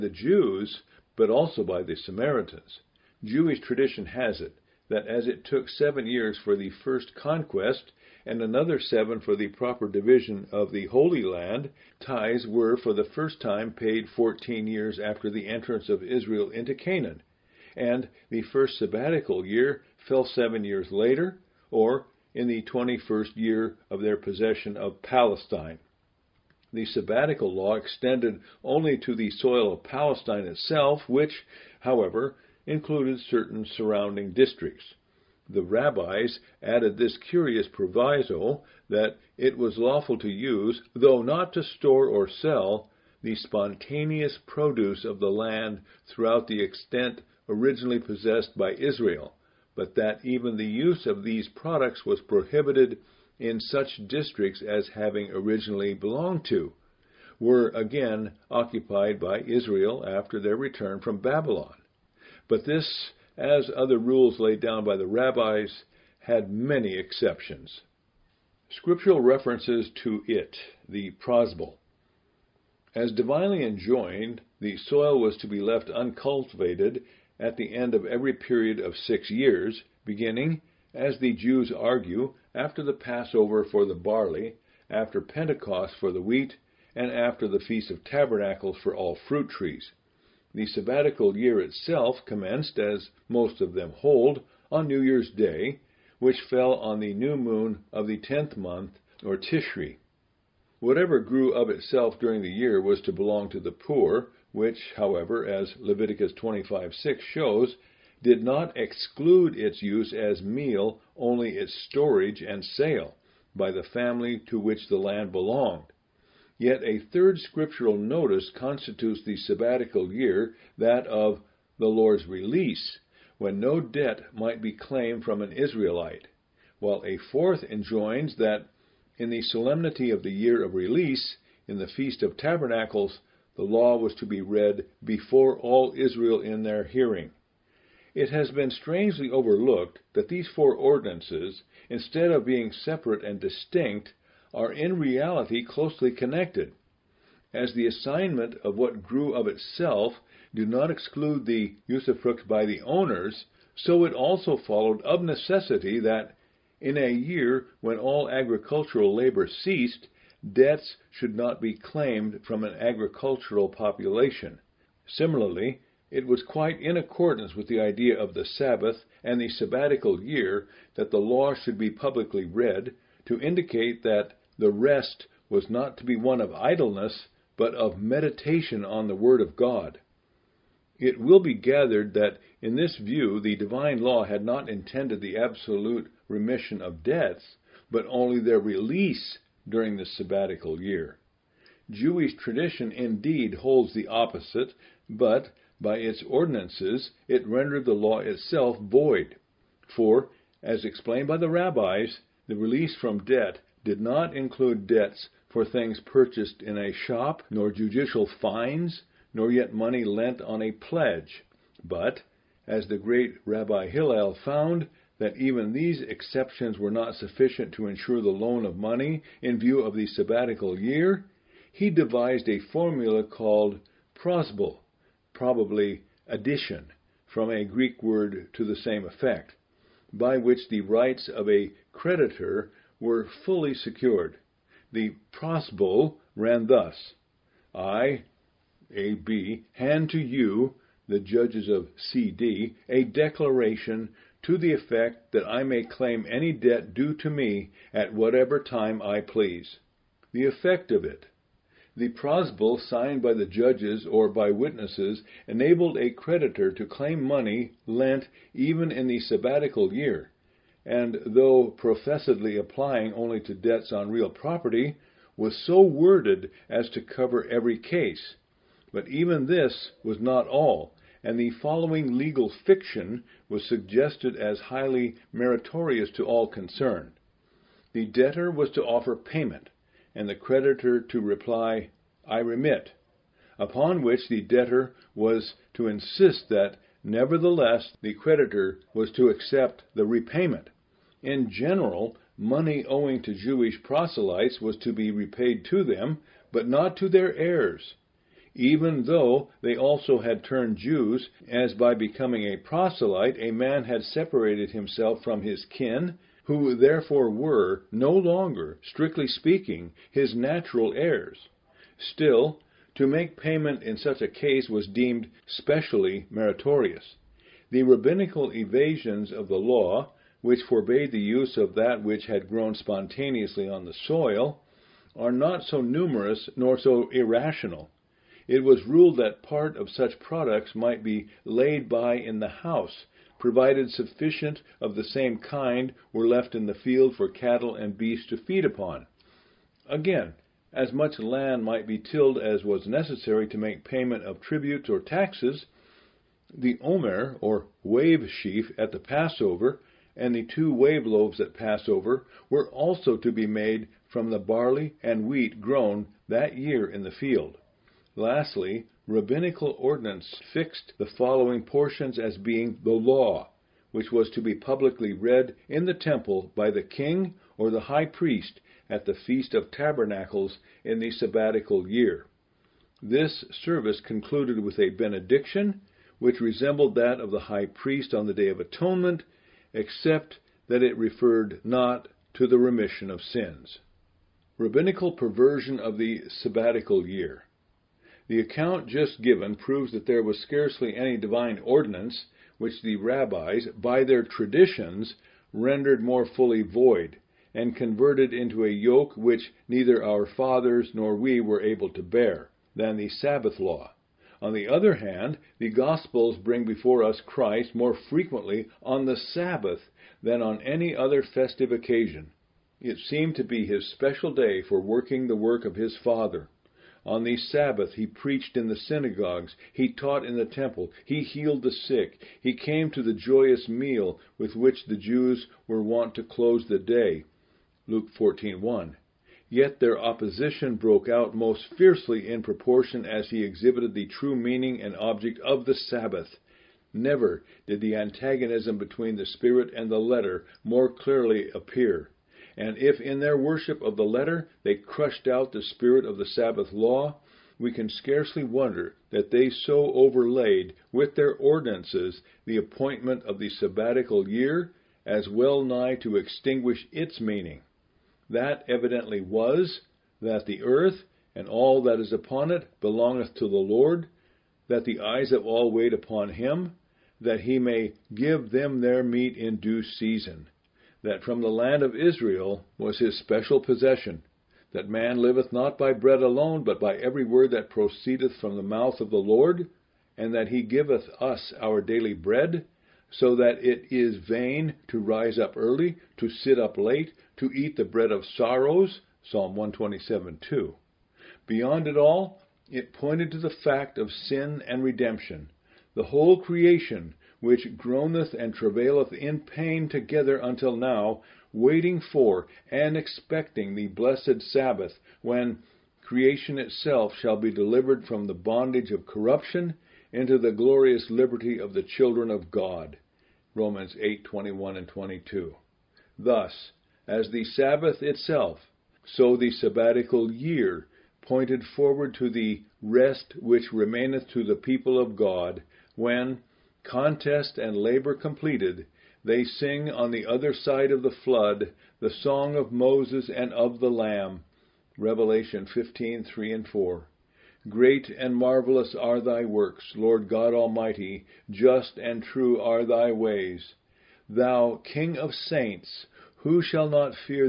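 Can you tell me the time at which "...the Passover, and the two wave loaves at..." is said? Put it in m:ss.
5:48.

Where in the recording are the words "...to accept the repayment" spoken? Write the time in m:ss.
4:49.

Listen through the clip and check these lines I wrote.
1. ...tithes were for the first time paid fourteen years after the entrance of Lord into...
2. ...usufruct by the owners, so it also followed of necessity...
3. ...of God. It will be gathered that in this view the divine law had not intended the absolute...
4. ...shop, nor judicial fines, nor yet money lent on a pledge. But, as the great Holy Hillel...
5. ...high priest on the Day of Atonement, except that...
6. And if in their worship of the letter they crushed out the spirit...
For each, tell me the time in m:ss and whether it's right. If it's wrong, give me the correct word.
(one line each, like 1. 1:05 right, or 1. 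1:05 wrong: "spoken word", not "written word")
1. 0:11 wrong: "Israel", not "Lord"
2. 2:31 right
3. 2:59 right
4. 3:26 wrong: "Rabbi", not "Holy"
5. 6:17 right
6. 7:22 right.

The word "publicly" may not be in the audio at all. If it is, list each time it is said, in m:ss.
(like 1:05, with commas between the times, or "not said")
2:51, 6:04.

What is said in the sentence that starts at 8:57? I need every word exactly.
Great and marvelous are thy works, Lord God Almighty, just and true are thy ways.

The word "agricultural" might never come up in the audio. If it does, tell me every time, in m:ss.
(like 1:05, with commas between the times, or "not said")
2:38, 2:42.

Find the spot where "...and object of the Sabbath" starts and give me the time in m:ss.
7:14.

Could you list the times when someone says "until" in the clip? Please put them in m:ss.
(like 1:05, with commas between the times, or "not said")
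8:20.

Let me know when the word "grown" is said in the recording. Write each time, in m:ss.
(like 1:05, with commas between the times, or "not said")
5:22, 5:55.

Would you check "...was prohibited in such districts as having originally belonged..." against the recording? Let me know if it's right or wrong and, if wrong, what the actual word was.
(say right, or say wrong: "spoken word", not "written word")
right.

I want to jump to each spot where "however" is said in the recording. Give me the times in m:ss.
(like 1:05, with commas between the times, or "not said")
0:31, 1:44.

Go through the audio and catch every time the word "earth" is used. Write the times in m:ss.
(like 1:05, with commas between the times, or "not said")
7:40.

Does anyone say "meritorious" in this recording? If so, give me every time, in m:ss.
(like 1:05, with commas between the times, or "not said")
4:35, 5:16.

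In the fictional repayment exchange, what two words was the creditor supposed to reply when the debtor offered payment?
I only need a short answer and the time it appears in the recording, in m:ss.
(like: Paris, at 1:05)
I remit, at 4:42.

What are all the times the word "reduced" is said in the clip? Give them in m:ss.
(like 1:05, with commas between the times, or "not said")
not said.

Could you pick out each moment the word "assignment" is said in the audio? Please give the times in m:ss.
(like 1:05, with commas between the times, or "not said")
2:27.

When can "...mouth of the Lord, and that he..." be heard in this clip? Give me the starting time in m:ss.
7:58.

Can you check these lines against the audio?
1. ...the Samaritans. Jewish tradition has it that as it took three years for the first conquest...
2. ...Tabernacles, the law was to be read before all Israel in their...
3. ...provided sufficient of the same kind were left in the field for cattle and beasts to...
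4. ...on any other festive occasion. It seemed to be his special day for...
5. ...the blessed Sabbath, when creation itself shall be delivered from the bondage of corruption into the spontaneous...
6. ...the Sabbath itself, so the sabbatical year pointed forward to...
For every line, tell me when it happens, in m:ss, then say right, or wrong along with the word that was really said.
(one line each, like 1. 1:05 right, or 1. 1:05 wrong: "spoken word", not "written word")
1. 0:01 wrong: "seven", not "three"
2. 2:12 right
3. 5:33 right
4. 6:50 right
5. 8:23 wrong: "glorious", not "spontaneous"
6. 8:37 right.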